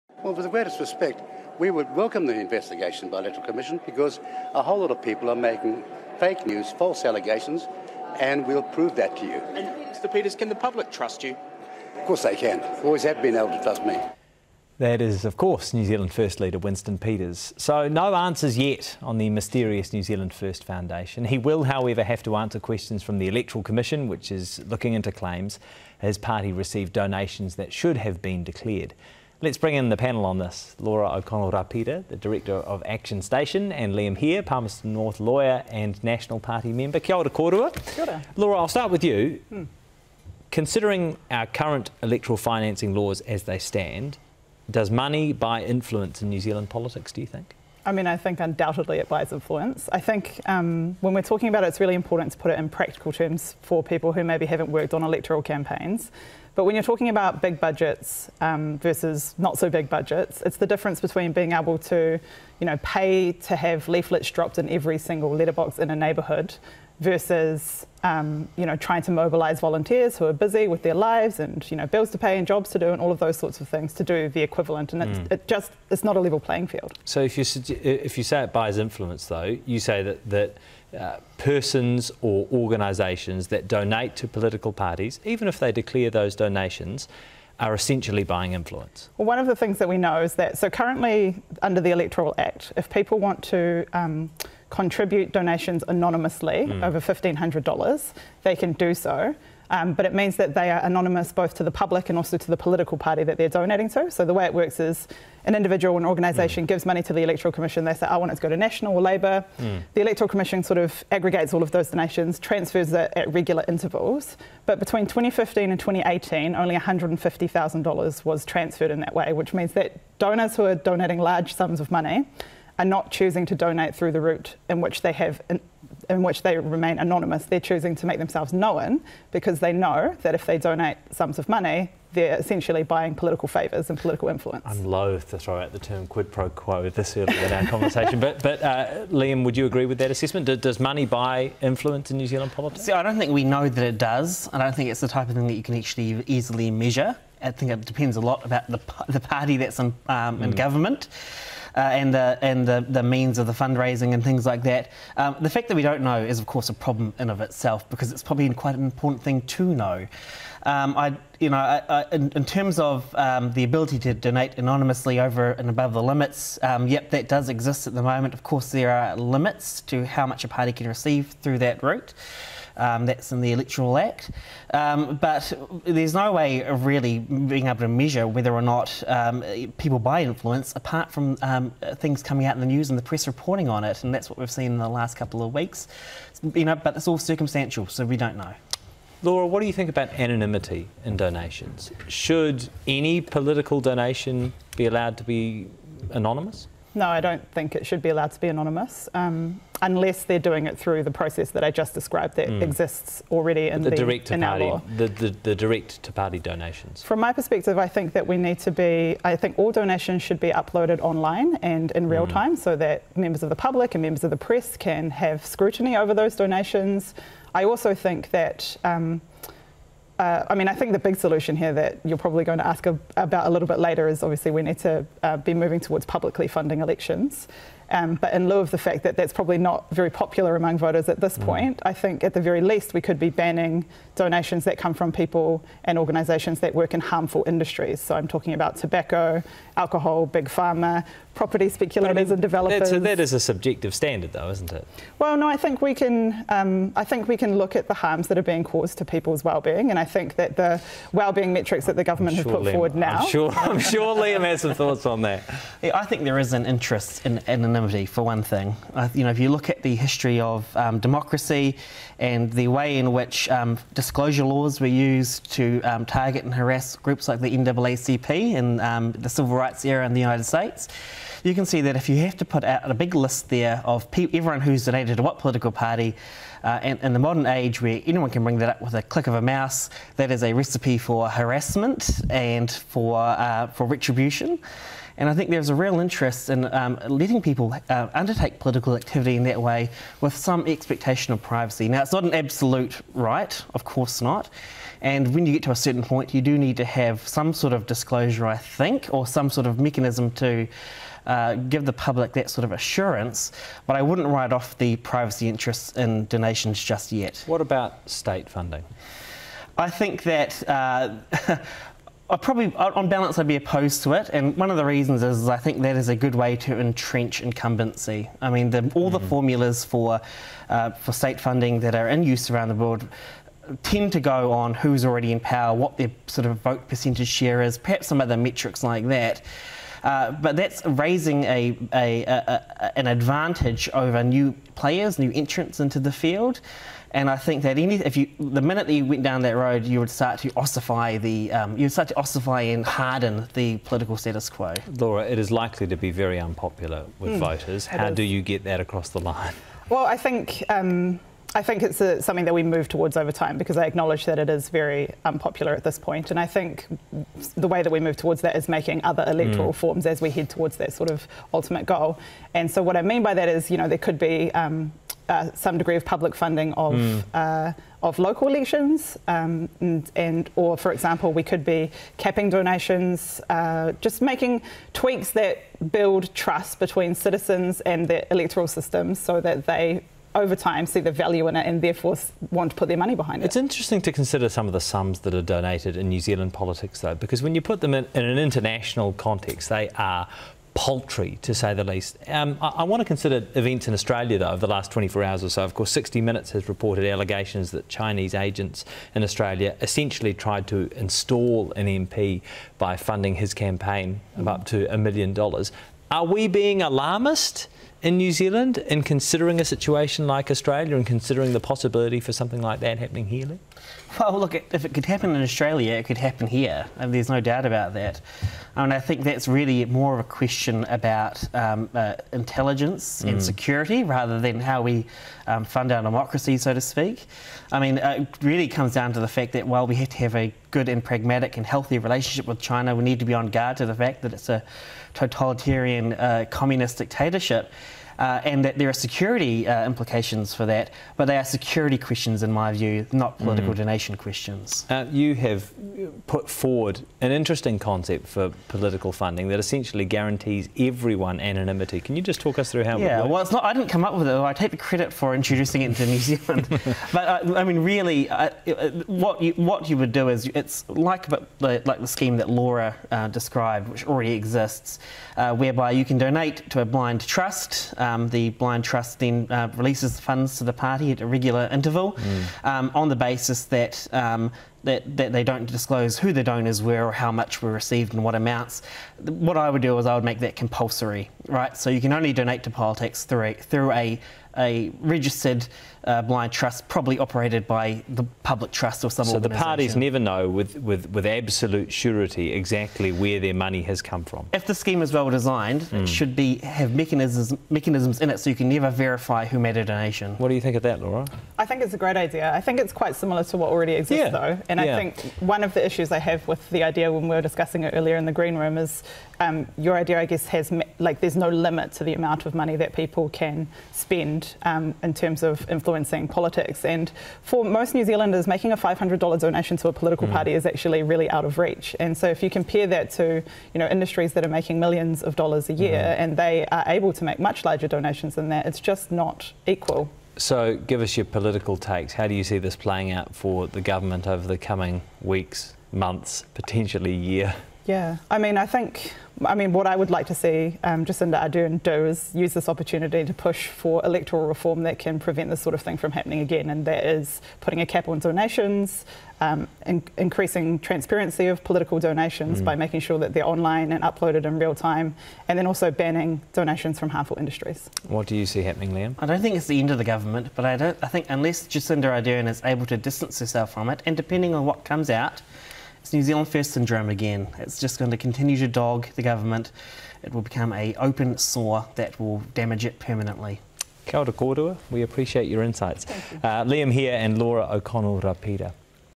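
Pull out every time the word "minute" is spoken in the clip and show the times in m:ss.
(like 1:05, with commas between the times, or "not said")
5:38, 6:36.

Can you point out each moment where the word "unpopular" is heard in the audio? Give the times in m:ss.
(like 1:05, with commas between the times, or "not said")
5:46, 5:55.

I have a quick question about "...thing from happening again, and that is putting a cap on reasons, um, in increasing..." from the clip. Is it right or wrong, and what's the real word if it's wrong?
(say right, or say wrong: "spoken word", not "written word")
wrong: "donations", not "reasons".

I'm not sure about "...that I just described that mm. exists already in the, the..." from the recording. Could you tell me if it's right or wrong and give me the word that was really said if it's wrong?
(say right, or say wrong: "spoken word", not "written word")
right.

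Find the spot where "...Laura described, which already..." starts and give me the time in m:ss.
7:42.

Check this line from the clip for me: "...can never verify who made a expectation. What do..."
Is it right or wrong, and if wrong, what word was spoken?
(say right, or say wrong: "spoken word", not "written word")
wrong: "donation", not "expectation".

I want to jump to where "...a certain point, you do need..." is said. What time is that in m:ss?
4:55.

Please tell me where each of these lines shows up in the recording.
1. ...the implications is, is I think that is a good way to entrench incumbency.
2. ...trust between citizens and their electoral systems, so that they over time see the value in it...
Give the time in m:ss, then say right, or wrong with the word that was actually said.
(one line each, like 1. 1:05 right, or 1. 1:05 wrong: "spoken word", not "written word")
1. 5:14 wrong: "reasons", not "implications"
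2. 6:16 right.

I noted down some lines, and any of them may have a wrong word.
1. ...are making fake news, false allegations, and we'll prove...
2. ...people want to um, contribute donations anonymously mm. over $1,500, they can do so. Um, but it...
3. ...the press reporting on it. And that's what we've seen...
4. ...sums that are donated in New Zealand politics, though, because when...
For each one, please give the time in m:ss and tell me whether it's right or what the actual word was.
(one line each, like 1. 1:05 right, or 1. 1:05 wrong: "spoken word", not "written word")
1. 0:05 right
2. 1:32 right
3. 3:02 right
4. 6:24 right.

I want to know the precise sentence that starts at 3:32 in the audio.
time, so that members of the public and members of the press can have scrutiny over those donations.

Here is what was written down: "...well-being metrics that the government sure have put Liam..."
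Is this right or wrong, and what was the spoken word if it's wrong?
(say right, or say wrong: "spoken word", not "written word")
right.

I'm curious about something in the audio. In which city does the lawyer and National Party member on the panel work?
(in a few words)
Palmerston North.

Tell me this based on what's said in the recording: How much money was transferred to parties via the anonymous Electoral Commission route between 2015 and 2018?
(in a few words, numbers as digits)
$150,000.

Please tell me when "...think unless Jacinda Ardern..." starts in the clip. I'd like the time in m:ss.
9:21.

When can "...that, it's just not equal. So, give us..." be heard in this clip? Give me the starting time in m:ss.
8:48.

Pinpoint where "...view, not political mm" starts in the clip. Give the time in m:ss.
7:22.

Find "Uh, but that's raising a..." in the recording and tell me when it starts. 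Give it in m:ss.
5:30.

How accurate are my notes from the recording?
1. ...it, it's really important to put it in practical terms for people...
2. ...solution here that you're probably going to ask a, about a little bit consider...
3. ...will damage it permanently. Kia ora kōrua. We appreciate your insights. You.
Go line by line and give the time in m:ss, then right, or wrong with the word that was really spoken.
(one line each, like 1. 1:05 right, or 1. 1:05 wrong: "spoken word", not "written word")
1. 0:51 right
2. 3:41 wrong: "later", not "consider"
3. 9:32 right.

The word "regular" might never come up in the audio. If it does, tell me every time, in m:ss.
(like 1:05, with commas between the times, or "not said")
1:53, 7:51.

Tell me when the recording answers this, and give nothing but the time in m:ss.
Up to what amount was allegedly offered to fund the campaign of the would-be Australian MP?
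6:44.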